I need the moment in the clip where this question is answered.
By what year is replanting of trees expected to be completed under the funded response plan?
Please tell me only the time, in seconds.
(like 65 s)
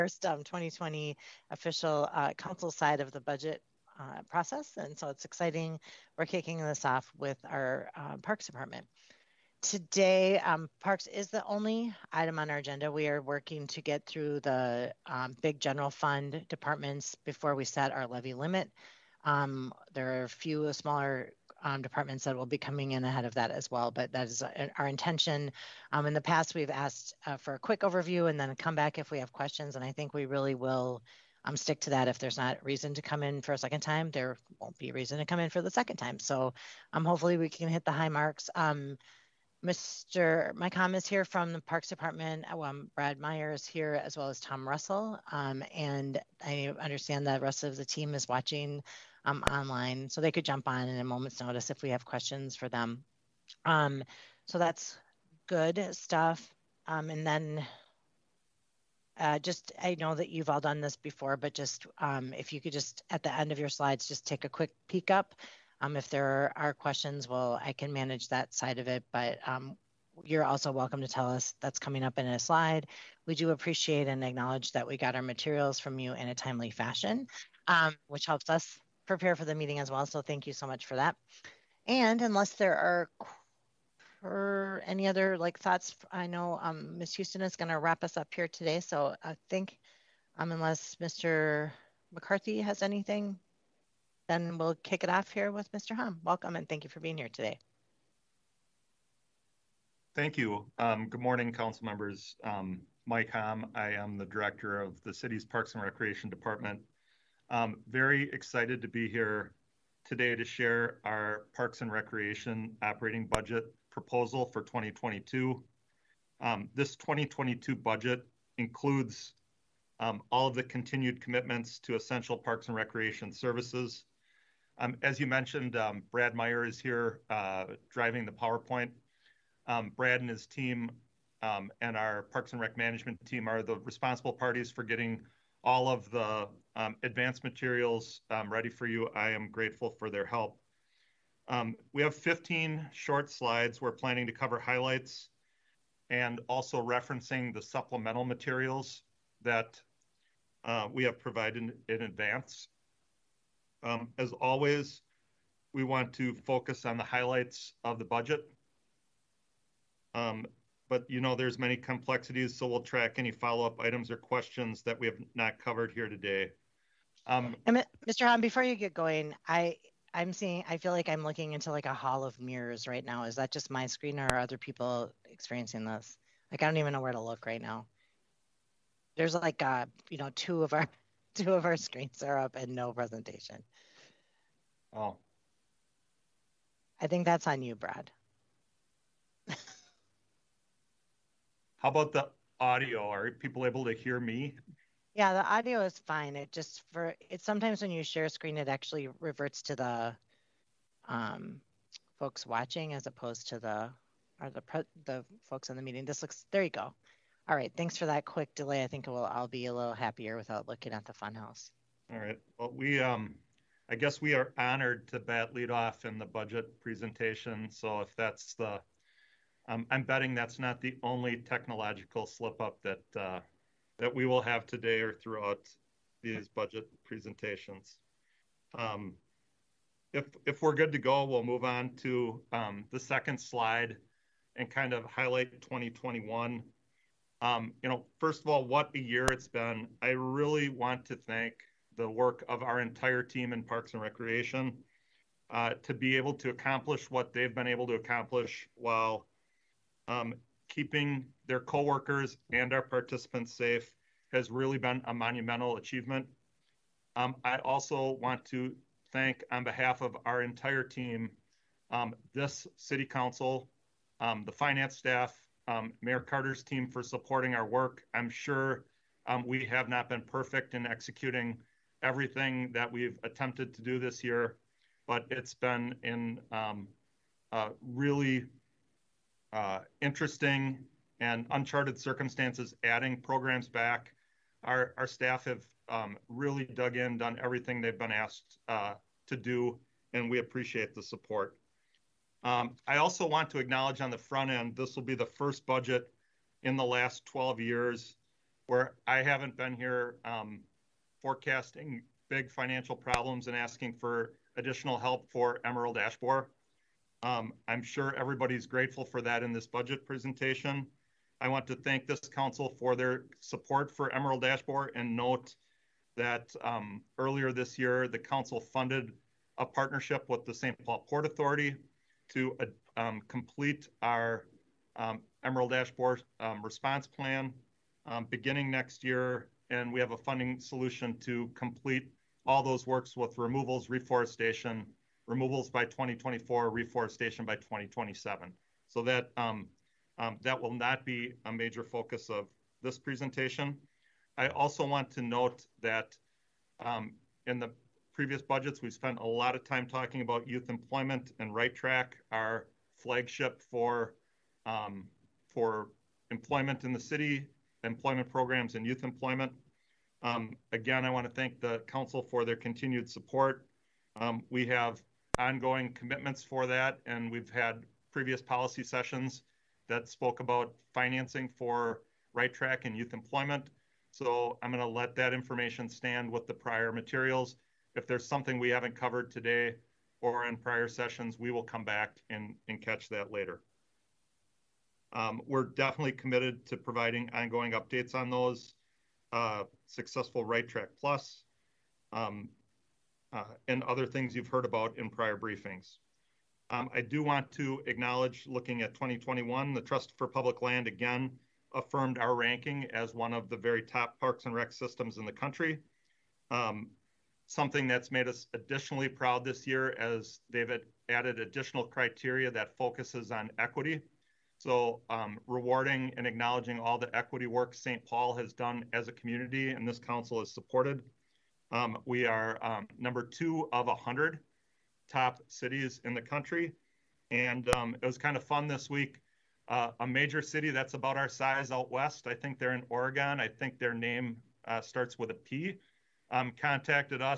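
337 s.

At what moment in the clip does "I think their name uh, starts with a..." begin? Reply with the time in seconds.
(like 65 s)
433 s.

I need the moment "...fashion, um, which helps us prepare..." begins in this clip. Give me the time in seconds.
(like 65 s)
76 s.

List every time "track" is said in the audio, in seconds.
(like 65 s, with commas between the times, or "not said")
162 s, 351 s, 372 s, 390 s.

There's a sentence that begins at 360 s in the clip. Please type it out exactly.
Um, again, I want to thank the council for their continued support.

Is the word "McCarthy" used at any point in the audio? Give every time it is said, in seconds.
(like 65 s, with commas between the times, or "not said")
92 s.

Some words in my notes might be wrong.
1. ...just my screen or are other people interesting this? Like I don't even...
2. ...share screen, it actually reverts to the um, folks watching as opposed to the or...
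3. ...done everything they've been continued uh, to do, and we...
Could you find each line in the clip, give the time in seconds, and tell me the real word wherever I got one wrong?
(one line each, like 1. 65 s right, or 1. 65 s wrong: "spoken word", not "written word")
1. 173 s wrong: "experiencing", not "interesting"
2. 198 s right
3. 287 s wrong: "asked", not "continued".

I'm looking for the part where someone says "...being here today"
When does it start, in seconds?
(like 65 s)
97 s.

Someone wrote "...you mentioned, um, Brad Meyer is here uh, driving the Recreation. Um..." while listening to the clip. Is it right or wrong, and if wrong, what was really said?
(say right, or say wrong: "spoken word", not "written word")
wrong: "PowerPoint", not "Recreation".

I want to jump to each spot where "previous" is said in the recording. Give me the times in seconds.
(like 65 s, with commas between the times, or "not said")
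348 s, 368 s.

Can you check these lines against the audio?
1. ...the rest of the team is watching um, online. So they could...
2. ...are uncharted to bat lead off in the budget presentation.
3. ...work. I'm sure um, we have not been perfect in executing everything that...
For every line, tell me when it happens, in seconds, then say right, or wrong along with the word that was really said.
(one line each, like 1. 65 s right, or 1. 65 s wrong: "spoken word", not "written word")
1. 47 s right
2. 214 s wrong: "honored", not "uncharted"
3. 267 s right.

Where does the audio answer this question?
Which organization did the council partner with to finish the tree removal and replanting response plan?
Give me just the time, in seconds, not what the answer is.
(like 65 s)
320 s.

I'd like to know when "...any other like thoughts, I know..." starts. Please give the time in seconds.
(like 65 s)
84 s.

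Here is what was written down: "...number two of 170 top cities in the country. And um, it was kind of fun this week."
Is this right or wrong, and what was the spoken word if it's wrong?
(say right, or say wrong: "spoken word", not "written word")
wrong: "100", not "170".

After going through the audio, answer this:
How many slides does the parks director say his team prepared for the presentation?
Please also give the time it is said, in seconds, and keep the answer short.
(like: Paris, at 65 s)
15, at 142 s.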